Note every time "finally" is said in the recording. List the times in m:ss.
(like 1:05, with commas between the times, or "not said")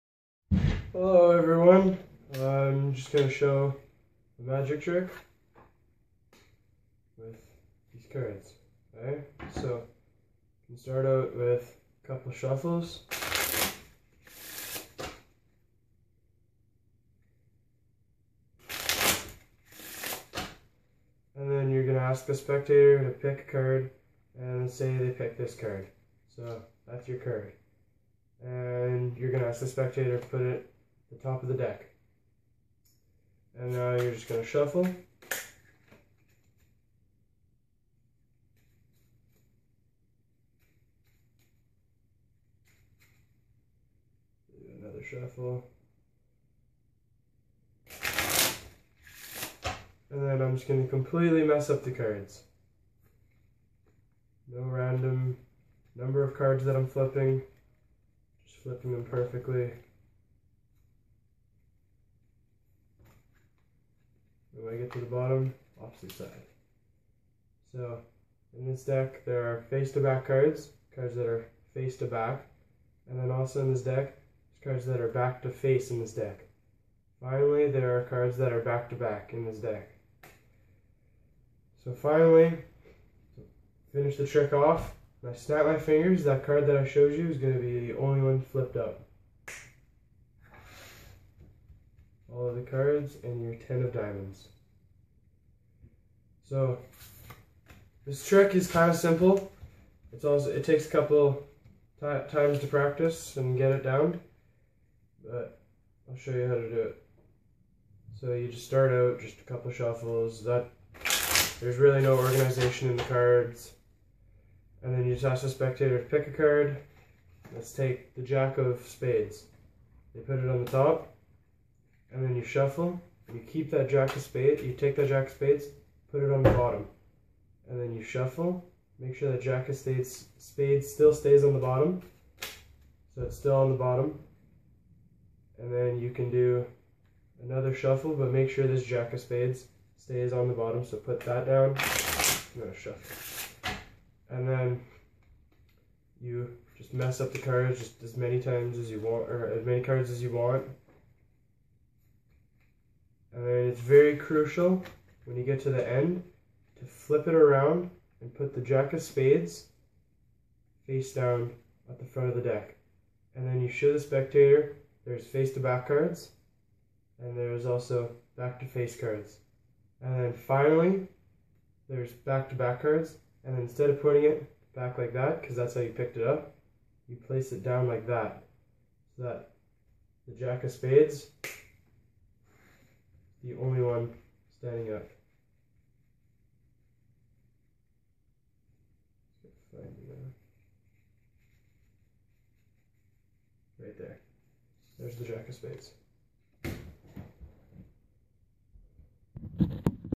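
1:17, 1:21, 2:50.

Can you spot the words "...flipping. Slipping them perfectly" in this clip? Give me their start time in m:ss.
0:56.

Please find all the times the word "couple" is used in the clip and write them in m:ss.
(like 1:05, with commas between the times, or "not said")
0:12, 1:40, 1:49.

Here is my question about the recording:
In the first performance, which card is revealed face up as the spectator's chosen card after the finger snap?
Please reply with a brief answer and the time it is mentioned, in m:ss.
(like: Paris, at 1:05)
10 of diamonds, at 1:33.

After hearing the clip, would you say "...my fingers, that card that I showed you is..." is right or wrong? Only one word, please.
right.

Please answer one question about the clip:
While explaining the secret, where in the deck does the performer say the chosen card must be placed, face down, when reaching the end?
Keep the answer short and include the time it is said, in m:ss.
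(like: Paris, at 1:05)
At the front of the deck, at 2:42.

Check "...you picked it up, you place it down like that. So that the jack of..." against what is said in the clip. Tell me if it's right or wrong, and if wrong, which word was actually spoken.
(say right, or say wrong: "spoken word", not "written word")
right.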